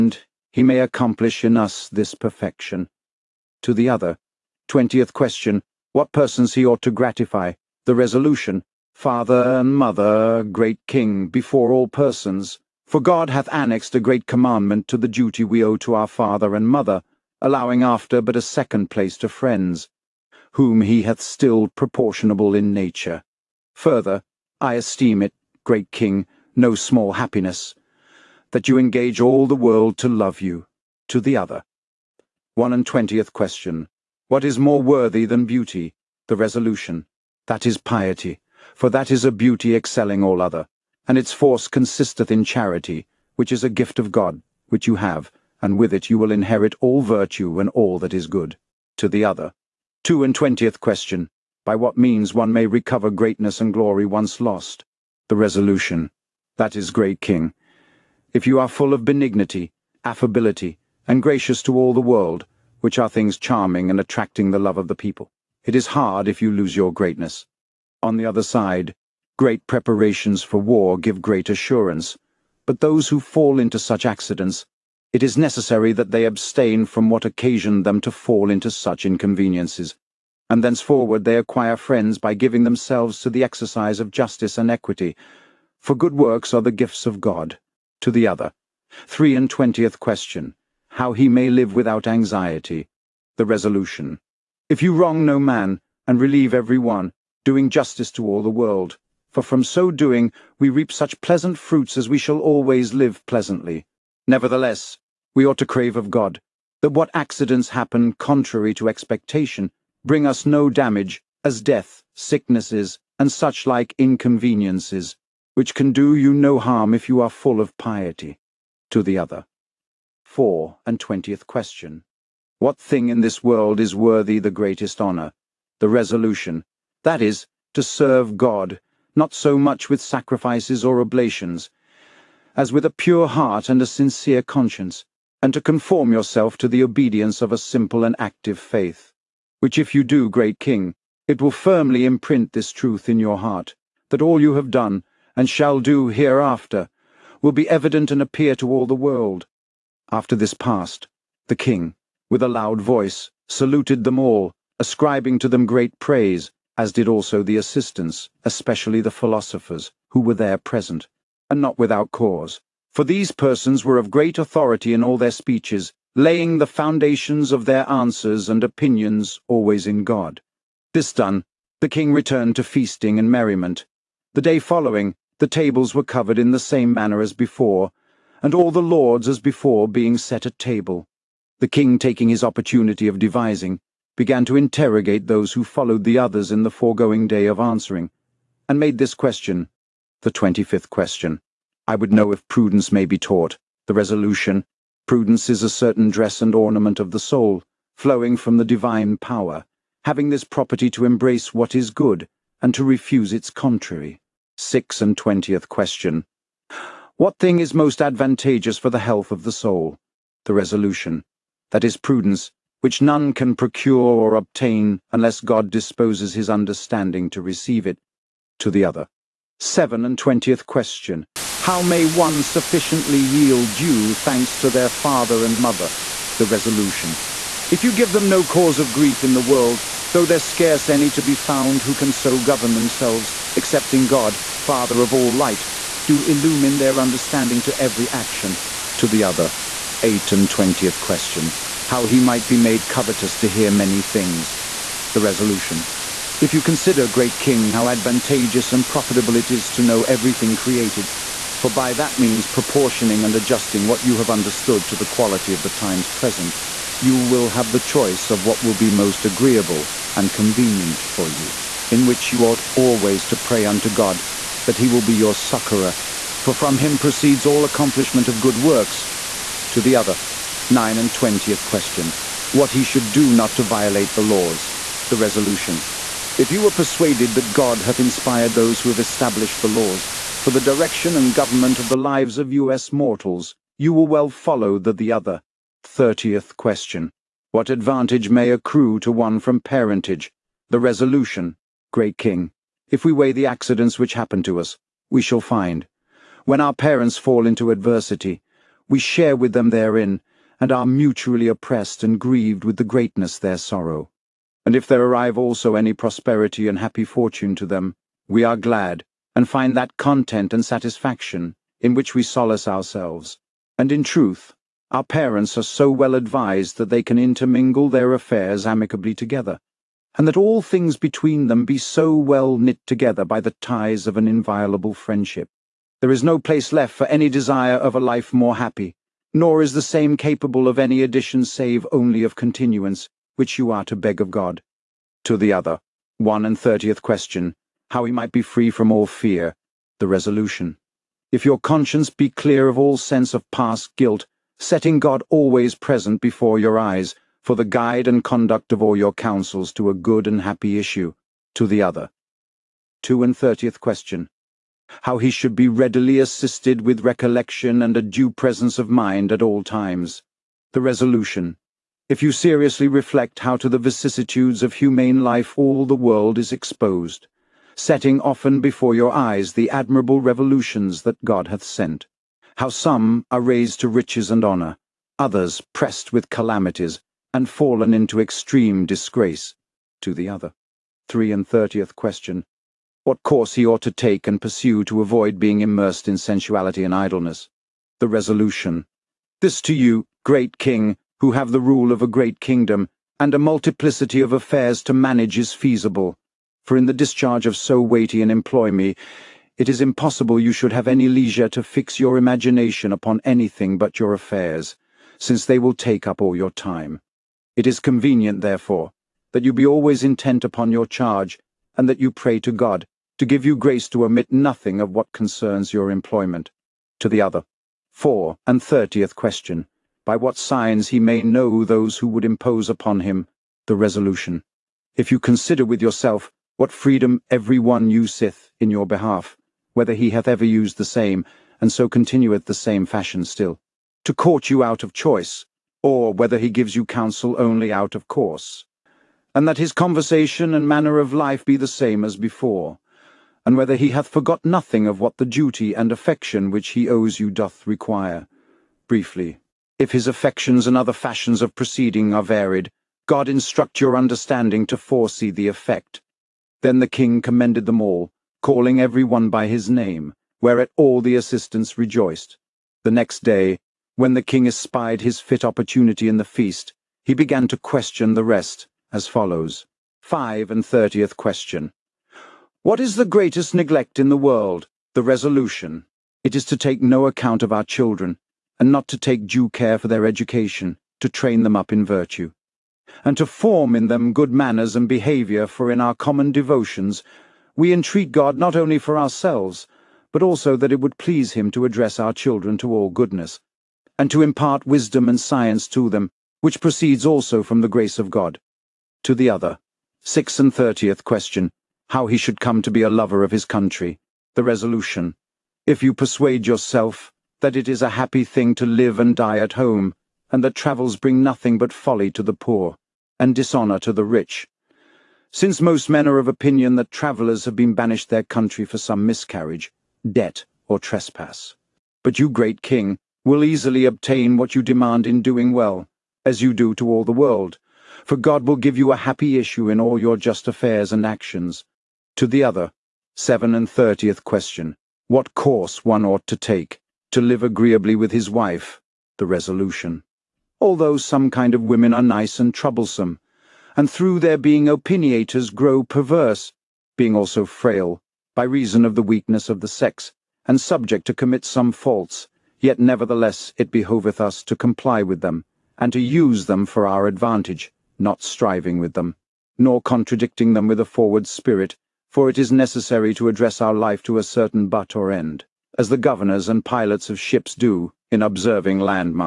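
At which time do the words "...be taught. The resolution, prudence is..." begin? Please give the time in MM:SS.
03:13.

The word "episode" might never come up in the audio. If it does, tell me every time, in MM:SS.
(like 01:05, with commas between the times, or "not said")
not said.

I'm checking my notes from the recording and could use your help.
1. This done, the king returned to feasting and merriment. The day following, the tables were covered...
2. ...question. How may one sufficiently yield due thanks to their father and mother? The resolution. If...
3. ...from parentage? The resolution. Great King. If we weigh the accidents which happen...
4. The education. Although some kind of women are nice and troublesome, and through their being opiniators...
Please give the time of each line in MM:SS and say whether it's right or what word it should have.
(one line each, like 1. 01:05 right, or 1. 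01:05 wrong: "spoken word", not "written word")
1. 02:50 right
2. 03:40 right
3. 04:49 right
4. 08:59 wrong: "resolution", not "education".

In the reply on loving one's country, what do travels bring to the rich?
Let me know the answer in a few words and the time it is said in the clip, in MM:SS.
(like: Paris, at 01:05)
Dishonour, at 08:33.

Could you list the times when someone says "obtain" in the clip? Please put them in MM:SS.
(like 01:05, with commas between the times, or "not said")
03:34, 08:43.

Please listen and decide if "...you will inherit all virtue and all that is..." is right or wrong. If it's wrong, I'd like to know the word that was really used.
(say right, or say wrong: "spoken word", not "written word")
right.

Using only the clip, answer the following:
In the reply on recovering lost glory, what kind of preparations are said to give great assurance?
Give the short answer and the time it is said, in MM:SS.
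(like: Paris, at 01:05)
Preparations for war, at 01:09.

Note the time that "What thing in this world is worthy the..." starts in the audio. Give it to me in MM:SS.
02:02.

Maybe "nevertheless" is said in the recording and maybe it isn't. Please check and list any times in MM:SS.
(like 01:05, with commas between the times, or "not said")
01:44, 09:12.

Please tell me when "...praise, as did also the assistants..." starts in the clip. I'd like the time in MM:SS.
02:36.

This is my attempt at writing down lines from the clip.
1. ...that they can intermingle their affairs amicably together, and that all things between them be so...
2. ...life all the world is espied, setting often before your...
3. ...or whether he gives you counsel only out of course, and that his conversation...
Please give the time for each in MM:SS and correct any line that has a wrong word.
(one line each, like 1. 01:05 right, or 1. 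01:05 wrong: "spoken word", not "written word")
1. 05:16 right
2. 06:05 wrong: "exposed", not "espied"
3. 07:15 right.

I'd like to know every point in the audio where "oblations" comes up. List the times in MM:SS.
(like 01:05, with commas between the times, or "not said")
02:10.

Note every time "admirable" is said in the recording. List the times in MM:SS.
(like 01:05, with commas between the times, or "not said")
06:09.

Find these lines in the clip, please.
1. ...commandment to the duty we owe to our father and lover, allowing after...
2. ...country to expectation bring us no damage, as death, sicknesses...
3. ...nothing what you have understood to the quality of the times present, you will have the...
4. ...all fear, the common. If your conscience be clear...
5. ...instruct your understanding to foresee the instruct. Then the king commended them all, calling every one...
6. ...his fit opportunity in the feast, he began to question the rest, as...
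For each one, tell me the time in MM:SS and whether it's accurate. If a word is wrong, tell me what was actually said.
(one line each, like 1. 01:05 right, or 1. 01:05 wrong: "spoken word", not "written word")
1. 00:14 wrong: "mother", not "lover"
2. 01:48 wrong: "contrary", not "country"
3. 04:13 wrong: "adjusting", not "nothing"
4. 05:38 wrong: "resolution", not "common"
5. 07:33 wrong: "effect", not "instruct"
6. 07:45 right.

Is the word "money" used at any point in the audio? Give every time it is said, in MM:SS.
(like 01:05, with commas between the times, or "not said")
not said.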